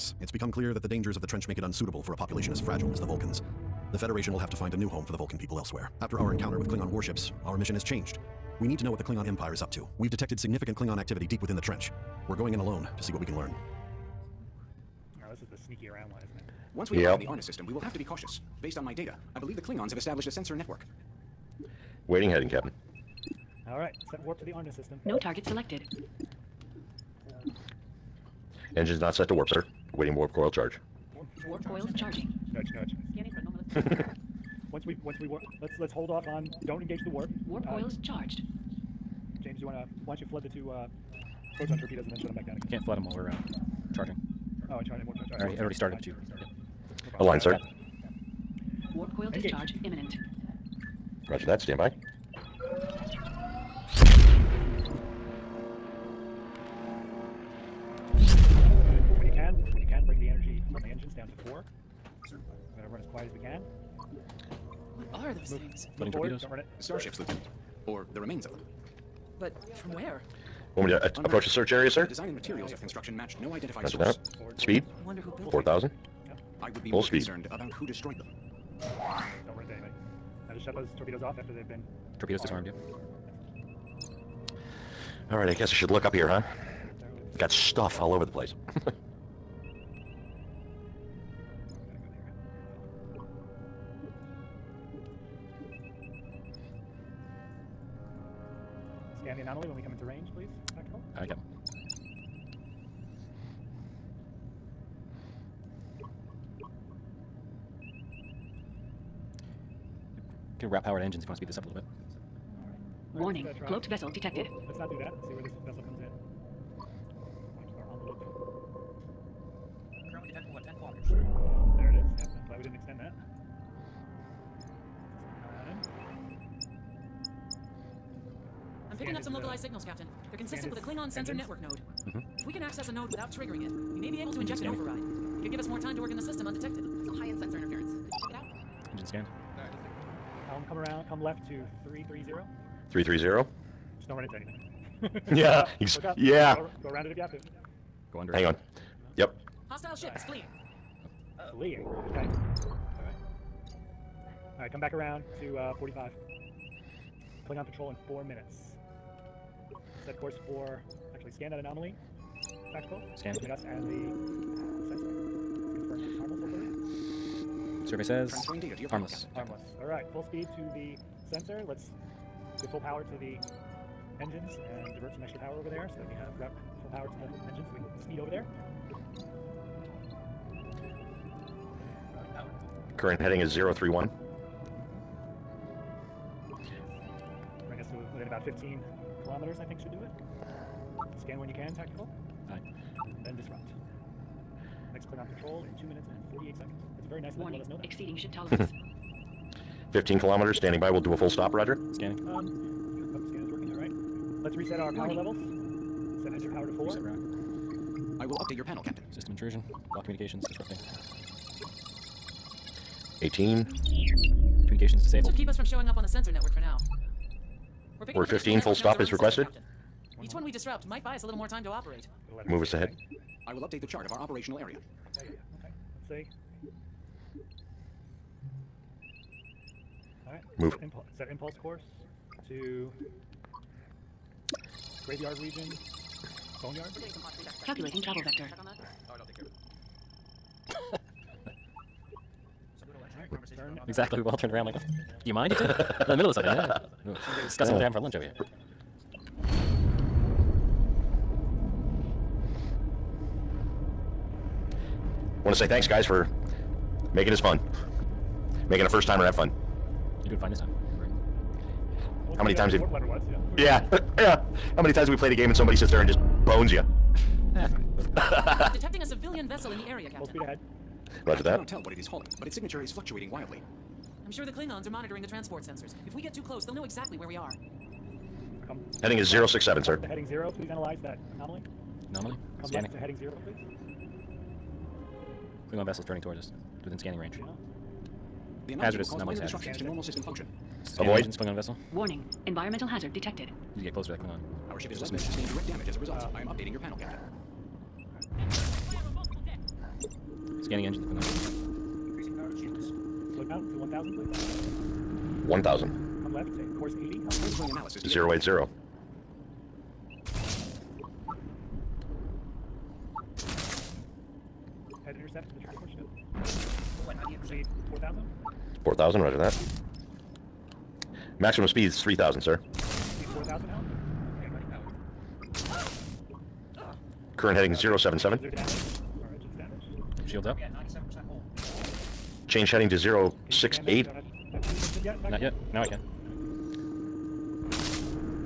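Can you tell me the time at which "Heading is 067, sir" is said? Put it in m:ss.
4:39.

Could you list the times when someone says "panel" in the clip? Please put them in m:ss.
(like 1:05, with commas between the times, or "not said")
3:28, 4:56.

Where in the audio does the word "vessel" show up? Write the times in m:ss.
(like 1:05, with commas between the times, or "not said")
1:53, 4:29, 4:45, 4:51.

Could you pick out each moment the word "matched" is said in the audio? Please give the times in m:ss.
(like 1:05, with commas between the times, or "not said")
1:13.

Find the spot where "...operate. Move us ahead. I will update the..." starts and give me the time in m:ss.
3:41.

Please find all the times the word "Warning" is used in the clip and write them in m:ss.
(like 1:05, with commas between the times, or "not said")
1:53, 4:51.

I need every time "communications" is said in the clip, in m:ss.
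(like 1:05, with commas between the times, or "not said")
3:30, 3:34.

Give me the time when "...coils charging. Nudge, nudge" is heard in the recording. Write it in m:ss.
0:31.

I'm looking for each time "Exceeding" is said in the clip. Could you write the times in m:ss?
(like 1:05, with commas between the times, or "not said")
3:17.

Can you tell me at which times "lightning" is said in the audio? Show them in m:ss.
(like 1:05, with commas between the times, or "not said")
not said.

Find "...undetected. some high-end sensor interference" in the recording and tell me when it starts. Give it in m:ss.
2:16.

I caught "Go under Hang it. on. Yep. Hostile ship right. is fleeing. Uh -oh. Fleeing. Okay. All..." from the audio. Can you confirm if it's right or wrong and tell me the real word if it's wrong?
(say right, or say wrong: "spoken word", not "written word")
right.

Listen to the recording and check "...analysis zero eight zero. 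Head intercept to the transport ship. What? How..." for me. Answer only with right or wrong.
right.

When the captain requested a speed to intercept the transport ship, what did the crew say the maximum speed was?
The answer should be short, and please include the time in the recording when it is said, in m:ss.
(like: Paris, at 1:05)
3000, at 5:22.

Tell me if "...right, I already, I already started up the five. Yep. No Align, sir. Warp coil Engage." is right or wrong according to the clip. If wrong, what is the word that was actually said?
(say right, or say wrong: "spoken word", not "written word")
wrong: "two", not "five".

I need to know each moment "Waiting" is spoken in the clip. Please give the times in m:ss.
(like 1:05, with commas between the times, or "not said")
0:22, 0:29.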